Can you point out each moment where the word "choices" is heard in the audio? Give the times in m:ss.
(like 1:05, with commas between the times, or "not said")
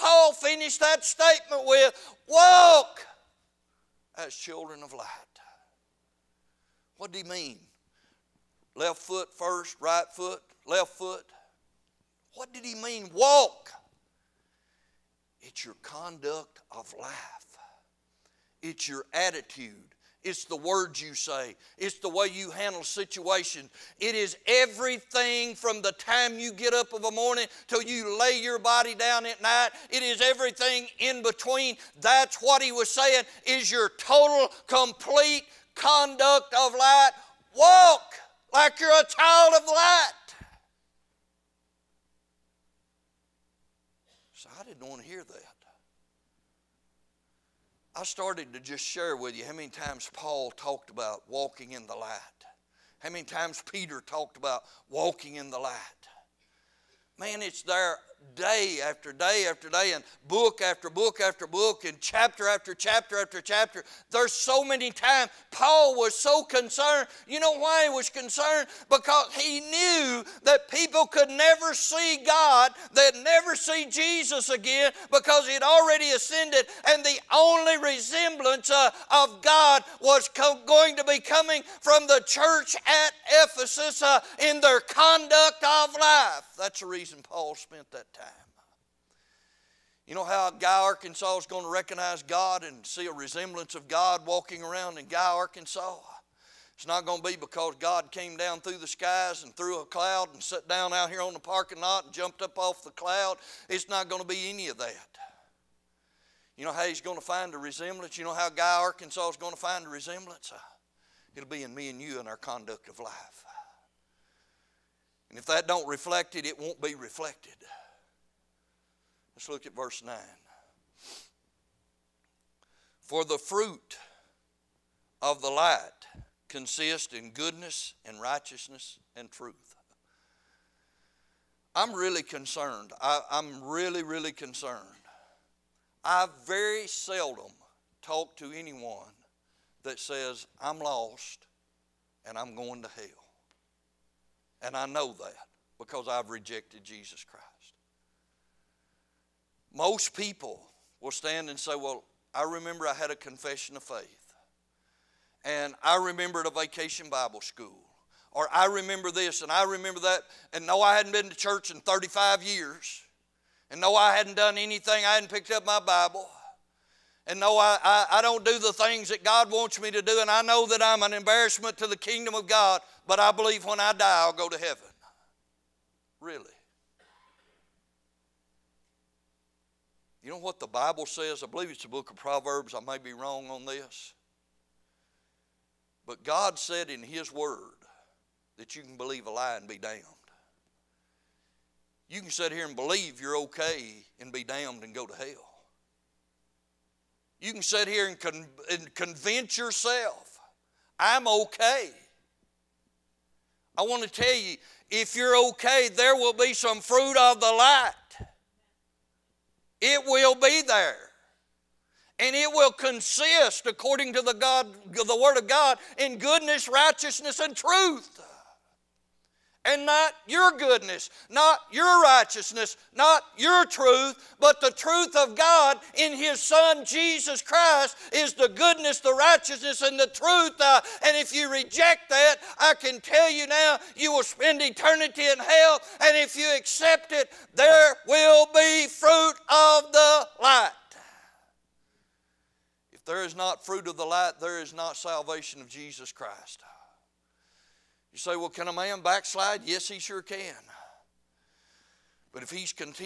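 not said.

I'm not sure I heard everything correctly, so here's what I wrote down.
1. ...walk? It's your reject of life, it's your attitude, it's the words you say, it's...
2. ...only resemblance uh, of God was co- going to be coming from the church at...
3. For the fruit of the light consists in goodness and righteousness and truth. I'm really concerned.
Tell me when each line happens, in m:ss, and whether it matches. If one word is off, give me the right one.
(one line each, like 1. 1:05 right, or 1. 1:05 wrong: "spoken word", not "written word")
1. 0:13 wrong: "conduct", not "reject"
2. 1:17 right
3. 2:03 right.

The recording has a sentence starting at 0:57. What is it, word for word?
Man, it's there day after day after day and book after book after book and chapter after chapter after chapter.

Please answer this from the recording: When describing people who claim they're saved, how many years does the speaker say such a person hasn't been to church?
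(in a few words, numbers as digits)
35.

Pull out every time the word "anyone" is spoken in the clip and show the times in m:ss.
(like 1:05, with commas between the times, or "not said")
2:18.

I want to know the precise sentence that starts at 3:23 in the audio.
I want to tell you, if you're okay, there will be some fruit of the light.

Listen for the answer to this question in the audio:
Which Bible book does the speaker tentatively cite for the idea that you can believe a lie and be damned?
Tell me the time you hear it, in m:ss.
3:02.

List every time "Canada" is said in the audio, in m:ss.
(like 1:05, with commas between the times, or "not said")
not said.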